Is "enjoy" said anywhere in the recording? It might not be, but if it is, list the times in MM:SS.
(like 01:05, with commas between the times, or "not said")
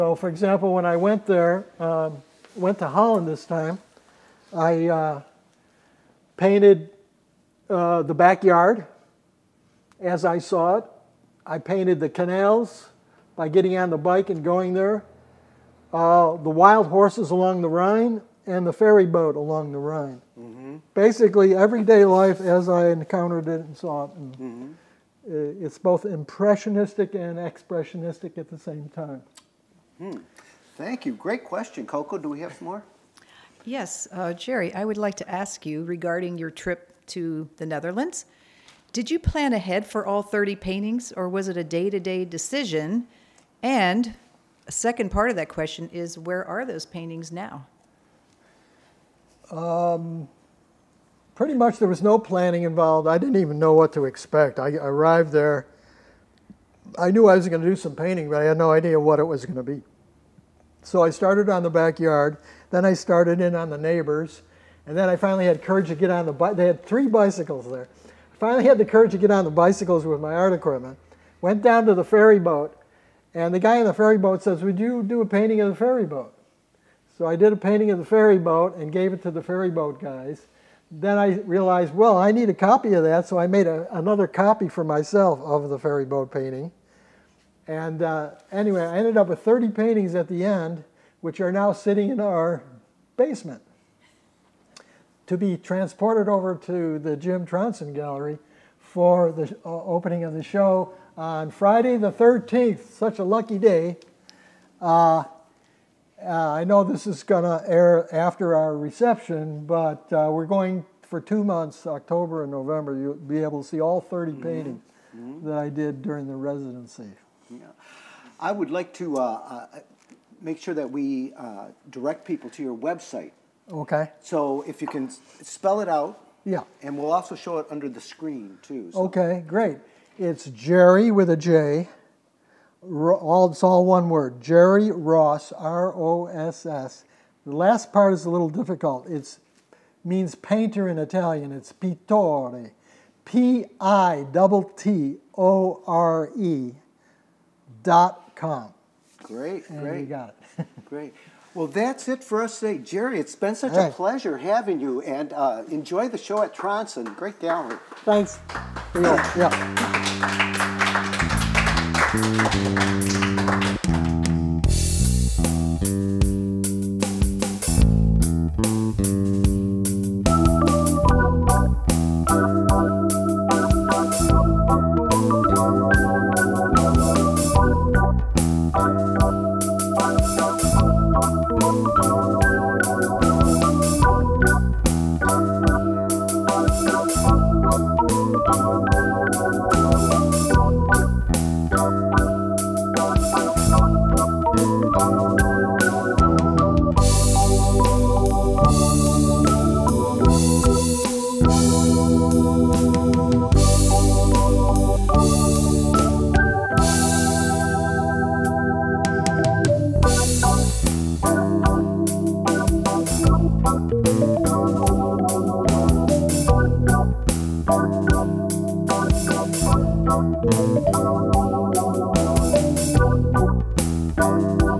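02:35.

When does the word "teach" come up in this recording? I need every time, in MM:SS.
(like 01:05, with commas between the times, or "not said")
not said.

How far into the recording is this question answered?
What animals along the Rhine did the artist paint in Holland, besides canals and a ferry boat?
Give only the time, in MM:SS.
00:16.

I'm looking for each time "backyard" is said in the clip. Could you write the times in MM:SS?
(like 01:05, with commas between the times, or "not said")
00:08, 01:01.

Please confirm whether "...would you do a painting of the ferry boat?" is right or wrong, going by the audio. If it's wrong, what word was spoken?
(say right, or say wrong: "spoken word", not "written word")
right.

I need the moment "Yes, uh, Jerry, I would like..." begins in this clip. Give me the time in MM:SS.
00:33.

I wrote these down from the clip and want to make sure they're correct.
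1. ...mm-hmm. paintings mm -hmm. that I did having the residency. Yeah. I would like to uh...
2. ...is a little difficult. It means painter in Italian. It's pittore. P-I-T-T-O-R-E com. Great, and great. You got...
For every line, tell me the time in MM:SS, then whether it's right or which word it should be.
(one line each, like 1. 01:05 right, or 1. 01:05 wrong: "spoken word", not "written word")
1. 01:54 wrong: "during", not "having"
2. 02:18 right.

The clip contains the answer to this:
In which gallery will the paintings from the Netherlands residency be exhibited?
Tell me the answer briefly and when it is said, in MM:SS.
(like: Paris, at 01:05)
Jim Tronson Gallery, at 01:37.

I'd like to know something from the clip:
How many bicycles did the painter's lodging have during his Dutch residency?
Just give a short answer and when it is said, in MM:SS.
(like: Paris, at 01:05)
3, at 01:06.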